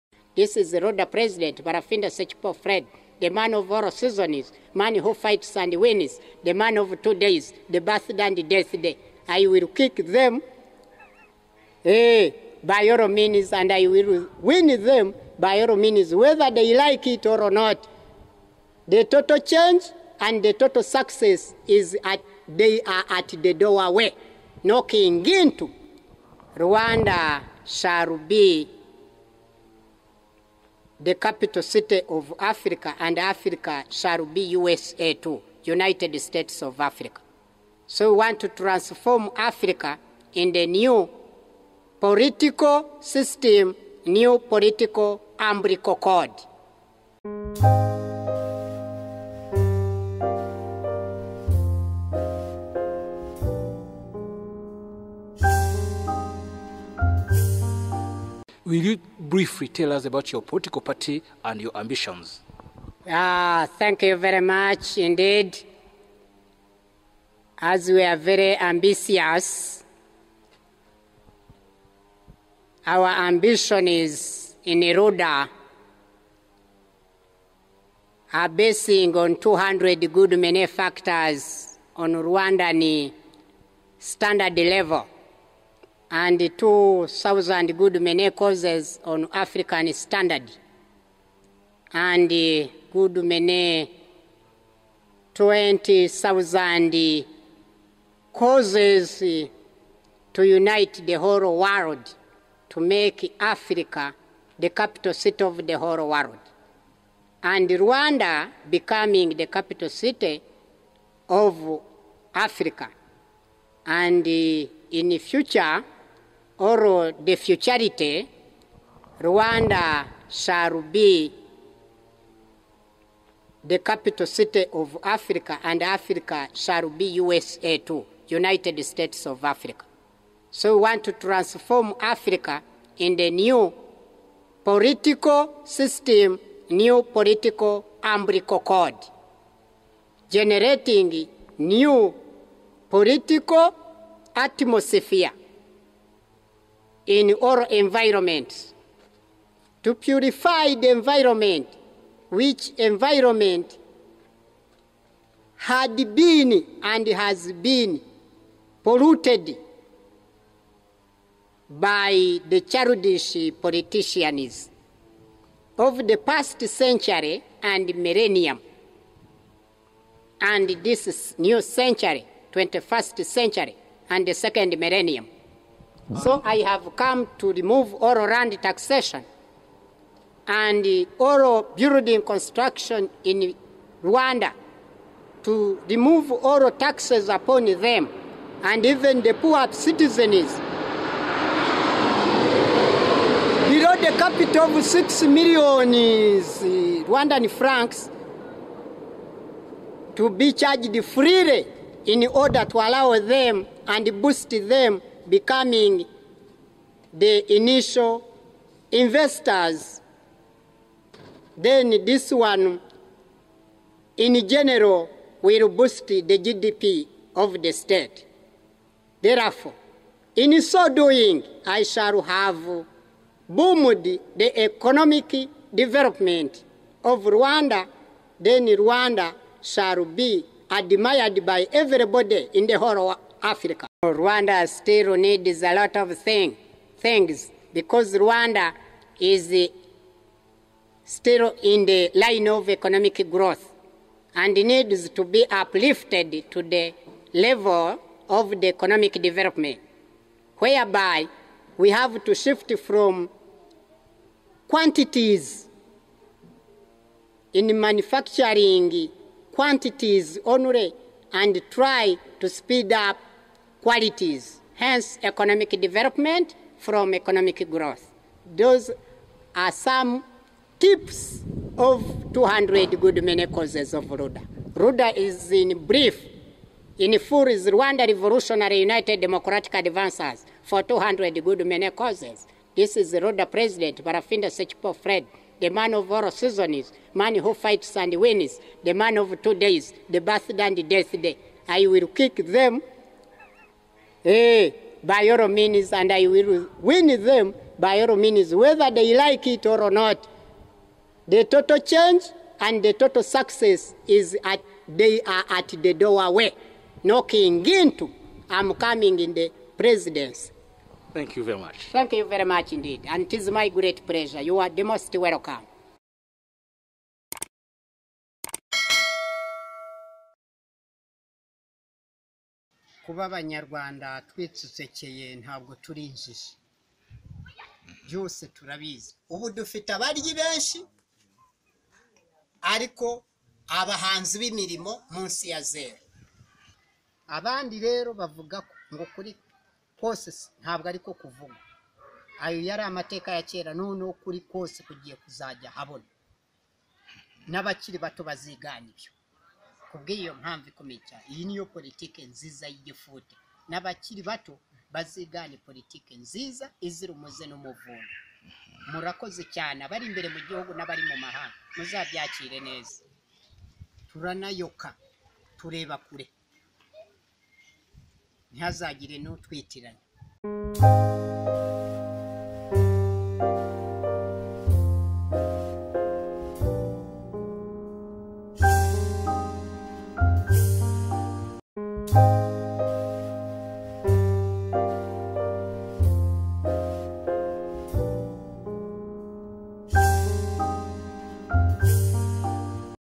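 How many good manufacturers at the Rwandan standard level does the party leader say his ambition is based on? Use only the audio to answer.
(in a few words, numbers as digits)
200.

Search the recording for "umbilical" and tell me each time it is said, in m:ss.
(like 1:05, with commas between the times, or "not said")
0:45, 2:18.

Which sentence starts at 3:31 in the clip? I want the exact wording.
Then this one, in general, will boost the GDP of the state.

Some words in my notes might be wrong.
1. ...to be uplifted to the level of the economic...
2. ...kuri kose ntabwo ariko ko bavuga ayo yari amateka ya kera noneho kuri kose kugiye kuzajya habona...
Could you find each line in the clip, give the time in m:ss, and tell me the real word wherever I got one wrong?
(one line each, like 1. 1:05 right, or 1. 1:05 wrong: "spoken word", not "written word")
1. 4:05 right
2. 5:39 wrong: "kuvuga", not "bavuga".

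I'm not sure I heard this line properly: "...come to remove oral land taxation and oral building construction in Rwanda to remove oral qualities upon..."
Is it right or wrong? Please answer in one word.
wrong.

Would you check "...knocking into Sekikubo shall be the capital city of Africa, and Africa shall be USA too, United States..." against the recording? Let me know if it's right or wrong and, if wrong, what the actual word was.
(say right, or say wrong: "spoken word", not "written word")
wrong: "Rwanda", not "Sekikubo".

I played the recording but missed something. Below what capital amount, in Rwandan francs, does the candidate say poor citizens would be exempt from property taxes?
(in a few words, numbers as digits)
6 million.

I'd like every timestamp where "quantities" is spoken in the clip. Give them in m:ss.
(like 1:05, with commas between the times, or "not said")
4:14, 4:19.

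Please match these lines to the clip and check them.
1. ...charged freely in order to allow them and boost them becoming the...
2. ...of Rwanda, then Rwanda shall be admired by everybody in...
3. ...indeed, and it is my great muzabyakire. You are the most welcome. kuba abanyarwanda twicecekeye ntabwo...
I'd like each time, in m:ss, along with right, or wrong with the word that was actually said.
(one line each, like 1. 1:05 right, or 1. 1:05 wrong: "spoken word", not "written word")
1. 3:20 right
2. 3:47 right
3. 5:12 wrong: "pleasure", not "muzabyakire".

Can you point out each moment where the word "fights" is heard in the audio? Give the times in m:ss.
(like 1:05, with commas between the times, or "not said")
0:05, 4:47.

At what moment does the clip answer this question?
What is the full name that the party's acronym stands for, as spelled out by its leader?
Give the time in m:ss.
4:37.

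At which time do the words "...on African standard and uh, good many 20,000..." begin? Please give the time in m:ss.
1:29.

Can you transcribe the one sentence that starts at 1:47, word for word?
And Rwanda becoming the capital city of Africa.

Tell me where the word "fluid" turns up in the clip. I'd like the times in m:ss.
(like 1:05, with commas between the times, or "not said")
not said.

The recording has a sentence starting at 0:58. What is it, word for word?
Will you briefly tell us about your political party and your ambitions?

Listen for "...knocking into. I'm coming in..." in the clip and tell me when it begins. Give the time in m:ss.
5:07.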